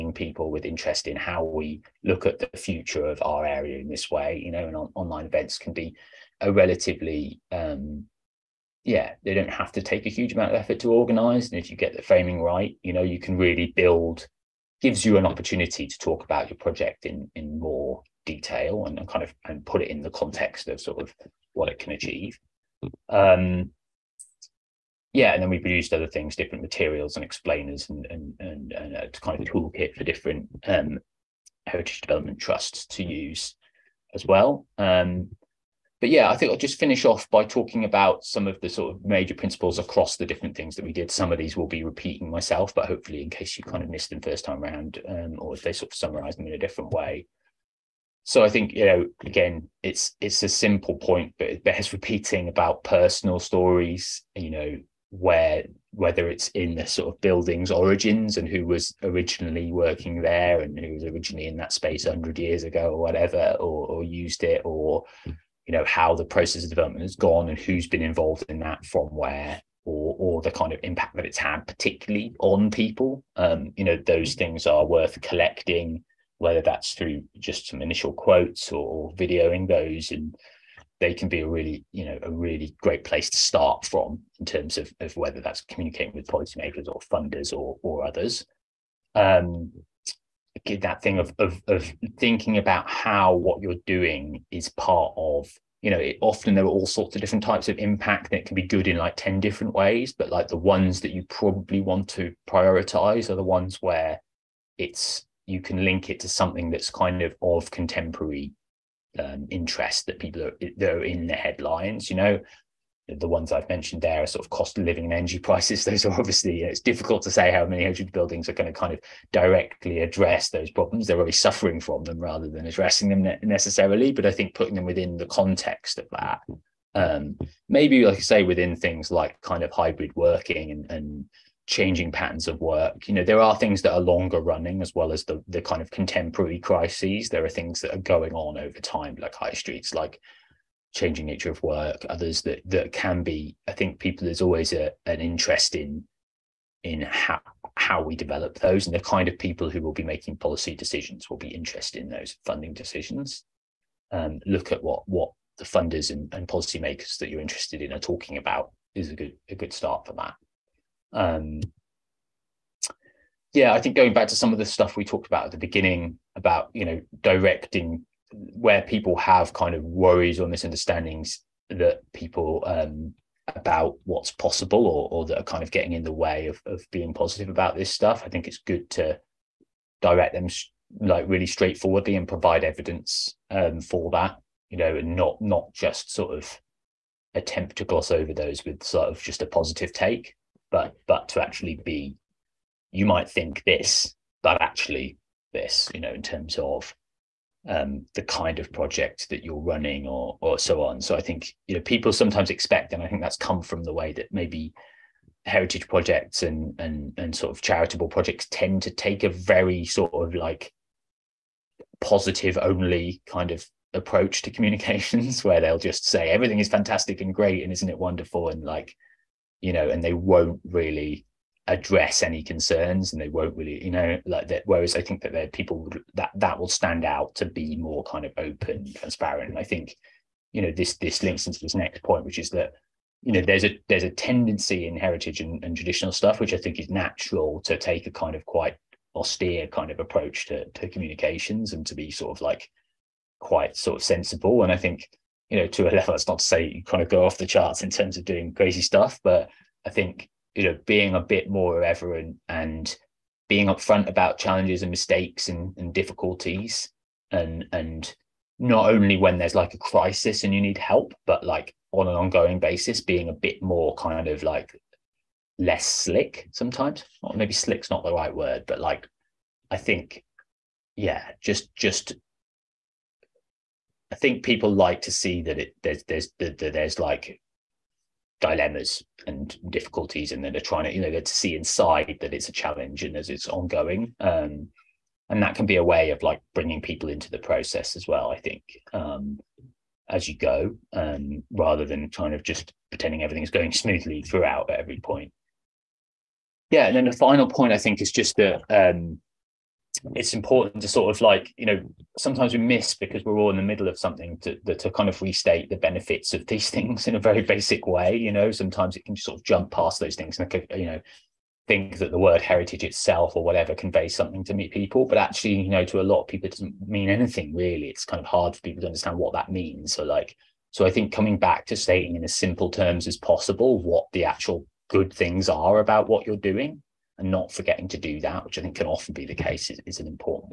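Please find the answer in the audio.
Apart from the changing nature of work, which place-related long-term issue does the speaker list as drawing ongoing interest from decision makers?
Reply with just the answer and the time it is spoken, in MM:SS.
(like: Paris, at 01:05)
high streets, at 02:19.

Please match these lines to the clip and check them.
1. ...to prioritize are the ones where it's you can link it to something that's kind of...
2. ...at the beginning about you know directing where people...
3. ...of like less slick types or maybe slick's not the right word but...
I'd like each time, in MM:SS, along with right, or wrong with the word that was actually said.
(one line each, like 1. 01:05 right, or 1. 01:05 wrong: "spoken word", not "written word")
1. 01:42 right
2. 02:45 right
3. 04:24 wrong: "sometimes", not "types".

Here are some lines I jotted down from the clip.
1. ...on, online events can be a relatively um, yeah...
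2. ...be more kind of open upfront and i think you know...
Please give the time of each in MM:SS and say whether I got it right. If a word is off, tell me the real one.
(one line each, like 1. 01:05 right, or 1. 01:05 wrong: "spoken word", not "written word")
1. 00:04 right
2. 03:47 wrong: "transparent", not "upfront".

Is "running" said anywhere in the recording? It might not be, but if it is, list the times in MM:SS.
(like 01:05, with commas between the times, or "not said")
02:14, 03:19.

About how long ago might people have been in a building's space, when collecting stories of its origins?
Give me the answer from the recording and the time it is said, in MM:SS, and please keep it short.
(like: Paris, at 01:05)
100 years, at 01:02.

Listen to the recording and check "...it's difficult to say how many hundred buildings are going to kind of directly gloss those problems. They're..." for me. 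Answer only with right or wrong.
wrong.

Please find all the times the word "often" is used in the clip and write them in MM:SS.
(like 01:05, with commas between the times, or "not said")
01:36, 05:28.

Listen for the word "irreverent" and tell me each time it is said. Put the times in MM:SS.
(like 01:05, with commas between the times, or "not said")
04:11.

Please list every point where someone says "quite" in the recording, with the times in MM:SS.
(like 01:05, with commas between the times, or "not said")
03:58, 04:03.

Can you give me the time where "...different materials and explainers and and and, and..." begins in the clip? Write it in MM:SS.
00:26.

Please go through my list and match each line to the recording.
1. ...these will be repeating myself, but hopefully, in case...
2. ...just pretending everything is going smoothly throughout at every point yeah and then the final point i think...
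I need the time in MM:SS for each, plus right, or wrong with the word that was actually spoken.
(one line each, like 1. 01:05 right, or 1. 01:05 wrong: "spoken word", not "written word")
1. 00:41 right
2. 04:52 right.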